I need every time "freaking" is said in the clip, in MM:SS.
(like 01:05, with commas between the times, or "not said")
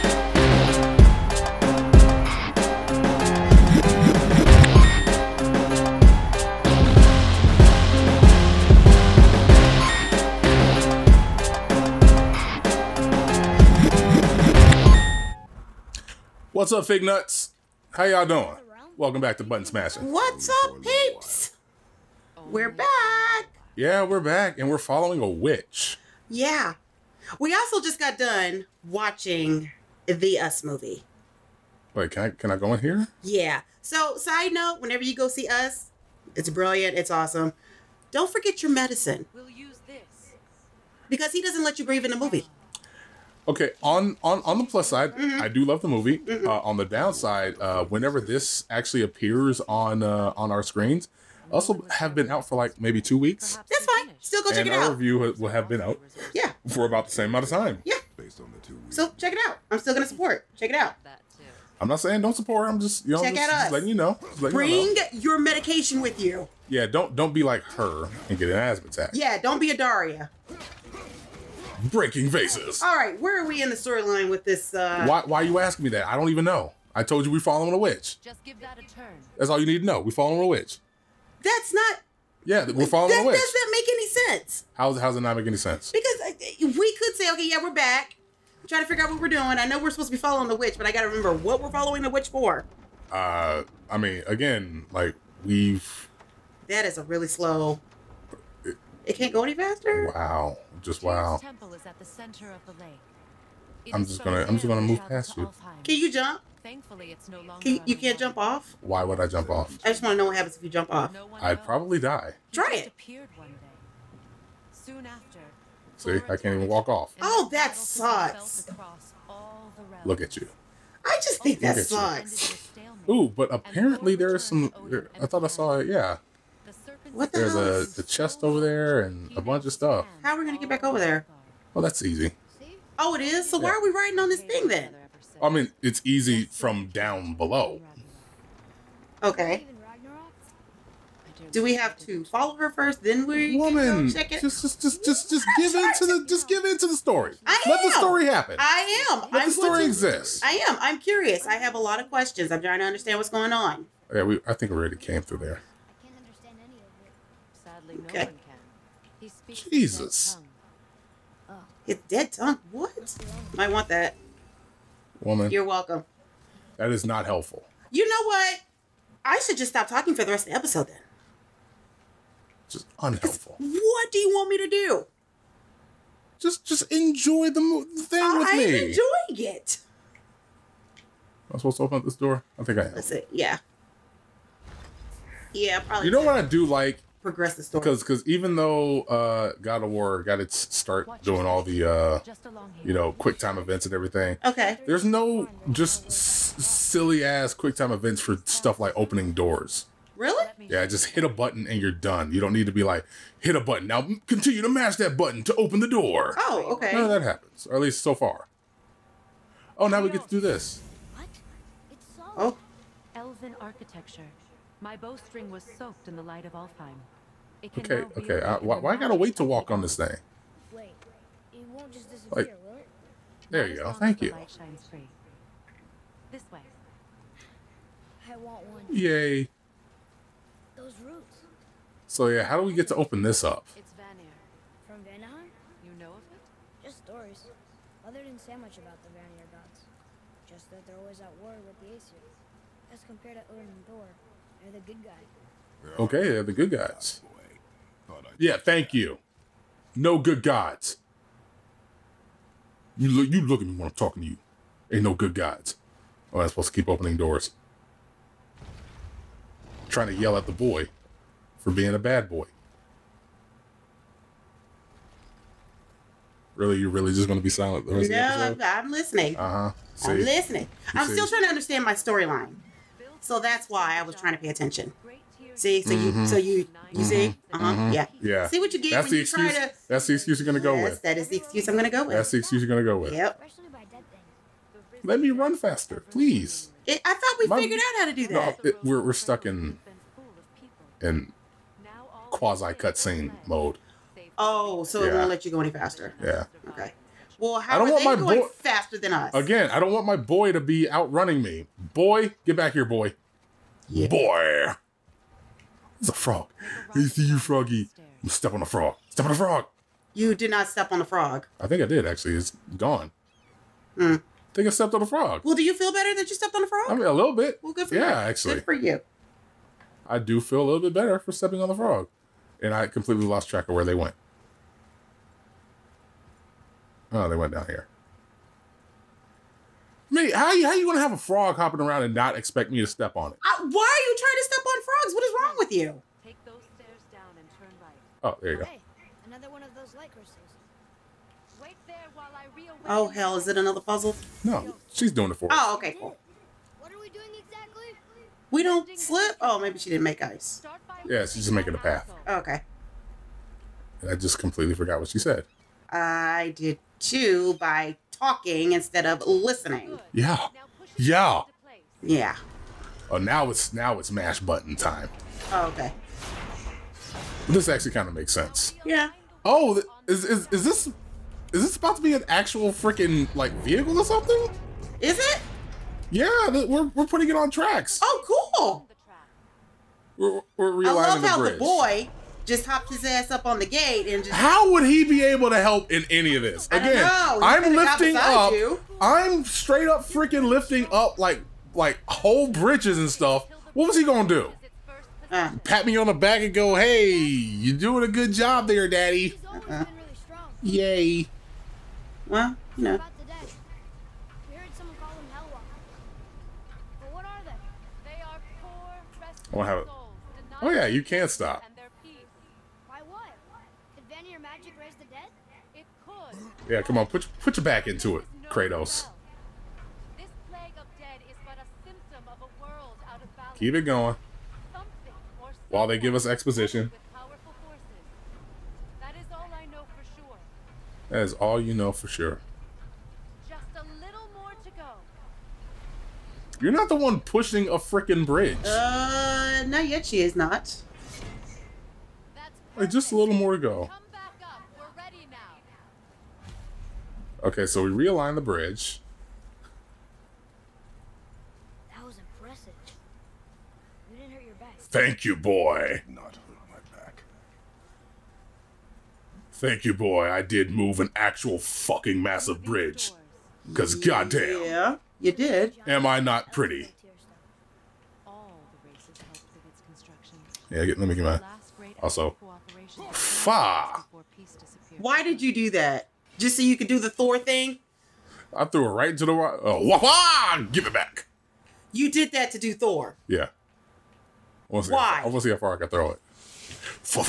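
06:12, 06:30, 07:17.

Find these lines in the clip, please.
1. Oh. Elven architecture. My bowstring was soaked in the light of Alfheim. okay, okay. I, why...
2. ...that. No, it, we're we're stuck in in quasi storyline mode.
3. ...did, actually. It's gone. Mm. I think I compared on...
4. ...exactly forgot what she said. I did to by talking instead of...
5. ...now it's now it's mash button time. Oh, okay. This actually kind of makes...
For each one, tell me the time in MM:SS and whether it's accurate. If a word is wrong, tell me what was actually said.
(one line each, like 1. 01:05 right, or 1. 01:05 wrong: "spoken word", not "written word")
1. 03:32 right
2. 04:48 wrong: "cutscene", not "storyline"
3. 05:11 wrong: "stepped", not "compared"
4. 05:54 wrong: "completely", not "exactly"
5. 06:03 right.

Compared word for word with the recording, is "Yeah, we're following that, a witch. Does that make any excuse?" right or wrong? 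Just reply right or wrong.
wrong.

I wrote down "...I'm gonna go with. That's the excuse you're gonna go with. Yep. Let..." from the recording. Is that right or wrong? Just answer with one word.
right.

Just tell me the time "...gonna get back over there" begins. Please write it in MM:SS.
02:10.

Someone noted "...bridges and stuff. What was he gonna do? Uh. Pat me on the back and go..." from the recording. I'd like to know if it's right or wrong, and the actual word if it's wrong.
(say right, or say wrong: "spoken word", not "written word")
right.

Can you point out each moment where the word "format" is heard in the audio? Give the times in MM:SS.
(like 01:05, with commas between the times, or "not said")
not said.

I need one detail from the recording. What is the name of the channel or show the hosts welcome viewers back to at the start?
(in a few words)
Button Smasher.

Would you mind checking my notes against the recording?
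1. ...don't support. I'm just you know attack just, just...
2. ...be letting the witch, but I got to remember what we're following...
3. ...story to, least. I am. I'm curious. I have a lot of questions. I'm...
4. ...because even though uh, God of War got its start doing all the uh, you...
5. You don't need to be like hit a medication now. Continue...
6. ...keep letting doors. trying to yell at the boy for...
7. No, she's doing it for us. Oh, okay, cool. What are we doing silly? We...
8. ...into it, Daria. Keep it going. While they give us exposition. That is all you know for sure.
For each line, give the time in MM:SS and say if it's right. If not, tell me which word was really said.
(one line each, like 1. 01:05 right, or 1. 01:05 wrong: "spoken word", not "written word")
1. 01:02 wrong: "check", not "attack"
2. 01:30 wrong: "following", not "letting"
3. 02:29 wrong: "exist", not "least"
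4. 03:08 right
5. 03:22 wrong: "button", not "medication"
6. 04:16 wrong: "opening", not "letting"
7. 05:44 wrong: "exactly", not "silly"
8. 06:57 wrong: "Kratos", not "Daria".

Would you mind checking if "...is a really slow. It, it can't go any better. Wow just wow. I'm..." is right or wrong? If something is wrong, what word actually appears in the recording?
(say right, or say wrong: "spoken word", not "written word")
wrong: "faster", not "better".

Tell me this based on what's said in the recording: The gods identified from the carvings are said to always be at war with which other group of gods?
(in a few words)
Aesir.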